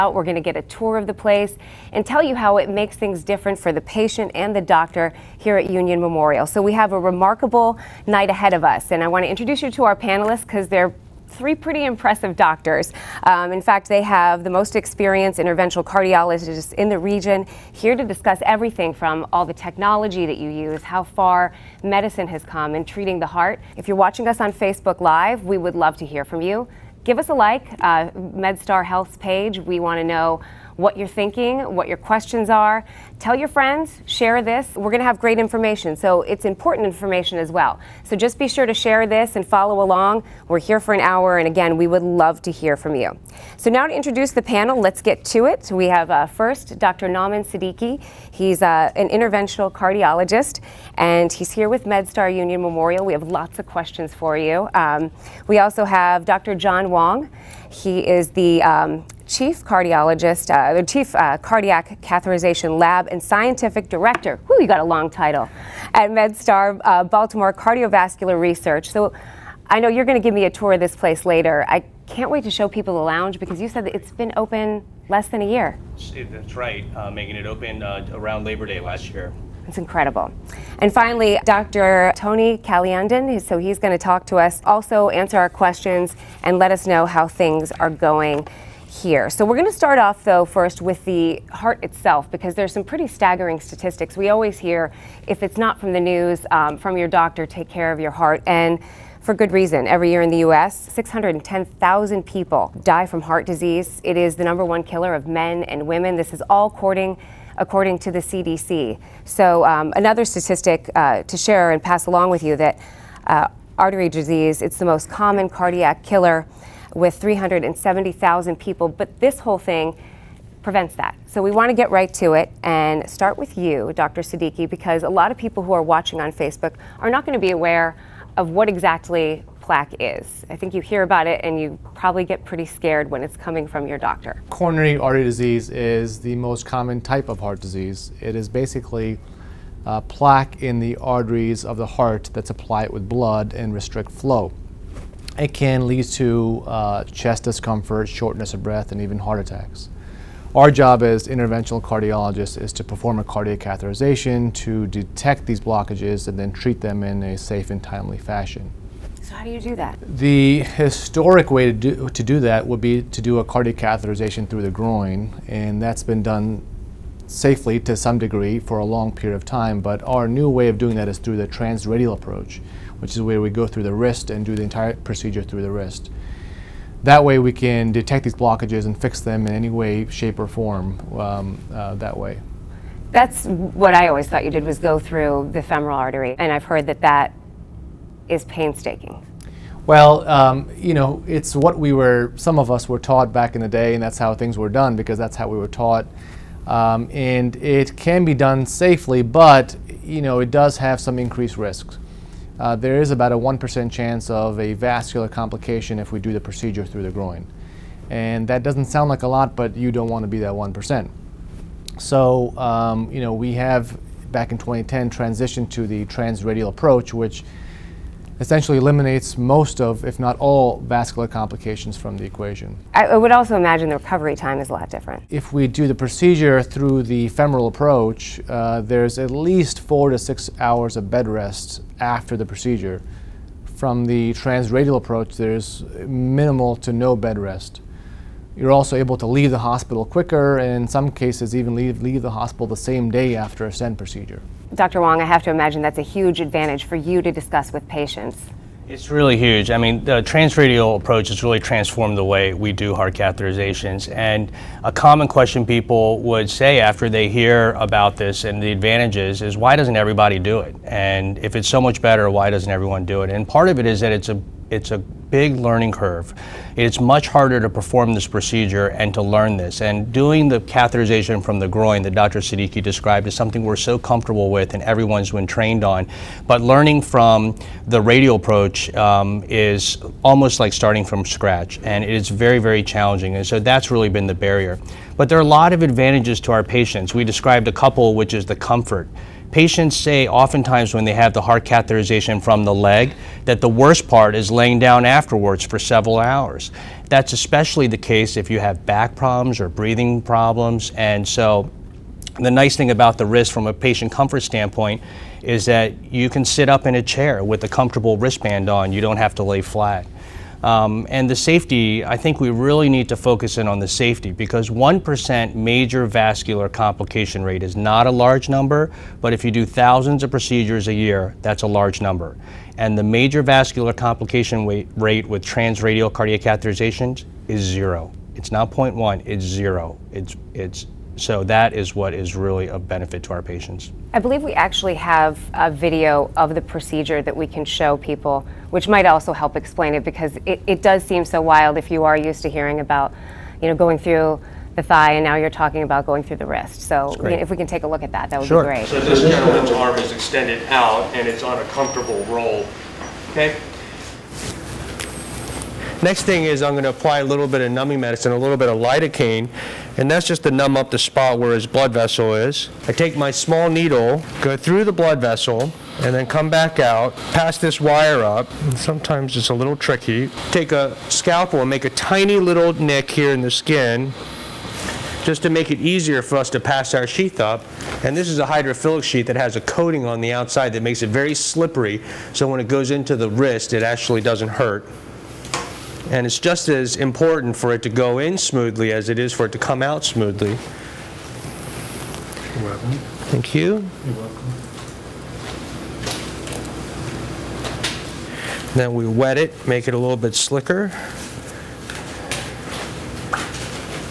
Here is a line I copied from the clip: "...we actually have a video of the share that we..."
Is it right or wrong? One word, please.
wrong.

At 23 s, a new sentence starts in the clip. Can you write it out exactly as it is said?
If you're watching us on Facebook Live, we would love to hear from you.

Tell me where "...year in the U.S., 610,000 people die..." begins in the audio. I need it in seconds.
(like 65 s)
100 s.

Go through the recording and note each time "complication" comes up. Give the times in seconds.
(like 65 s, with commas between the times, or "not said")
205 s, 221 s, 316 s, 323 s.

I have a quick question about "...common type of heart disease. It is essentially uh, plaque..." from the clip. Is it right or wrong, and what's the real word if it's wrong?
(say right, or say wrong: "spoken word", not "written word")
wrong: "basically", not "essentially".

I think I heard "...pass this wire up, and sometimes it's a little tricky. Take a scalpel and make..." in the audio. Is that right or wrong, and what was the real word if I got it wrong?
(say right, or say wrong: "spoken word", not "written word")
right.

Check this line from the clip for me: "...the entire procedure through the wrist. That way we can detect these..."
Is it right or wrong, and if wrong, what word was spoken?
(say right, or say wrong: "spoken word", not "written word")
right.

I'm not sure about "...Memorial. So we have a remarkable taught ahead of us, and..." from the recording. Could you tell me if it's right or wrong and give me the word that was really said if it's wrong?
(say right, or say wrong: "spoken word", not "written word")
wrong: "night", not "taught".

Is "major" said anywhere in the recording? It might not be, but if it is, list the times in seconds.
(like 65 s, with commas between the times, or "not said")
315 s, 323 s.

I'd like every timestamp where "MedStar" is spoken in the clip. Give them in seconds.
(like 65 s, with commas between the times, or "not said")
28 s, 51 s, 66 s.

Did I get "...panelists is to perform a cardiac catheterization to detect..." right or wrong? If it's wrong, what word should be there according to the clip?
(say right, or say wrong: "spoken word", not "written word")
wrong: "cardiologists", not "panelists".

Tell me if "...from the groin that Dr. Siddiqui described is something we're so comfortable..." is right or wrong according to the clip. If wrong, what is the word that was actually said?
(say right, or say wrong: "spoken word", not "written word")
right.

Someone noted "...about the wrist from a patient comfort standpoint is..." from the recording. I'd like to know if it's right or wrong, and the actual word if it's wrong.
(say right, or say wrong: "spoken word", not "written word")
right.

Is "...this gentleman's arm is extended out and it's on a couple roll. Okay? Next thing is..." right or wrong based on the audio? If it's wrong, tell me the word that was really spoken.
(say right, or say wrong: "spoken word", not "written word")
wrong: "comfortable", not "couple".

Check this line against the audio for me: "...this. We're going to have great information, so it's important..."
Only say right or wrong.
right.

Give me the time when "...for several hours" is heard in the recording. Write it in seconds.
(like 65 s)
295 s.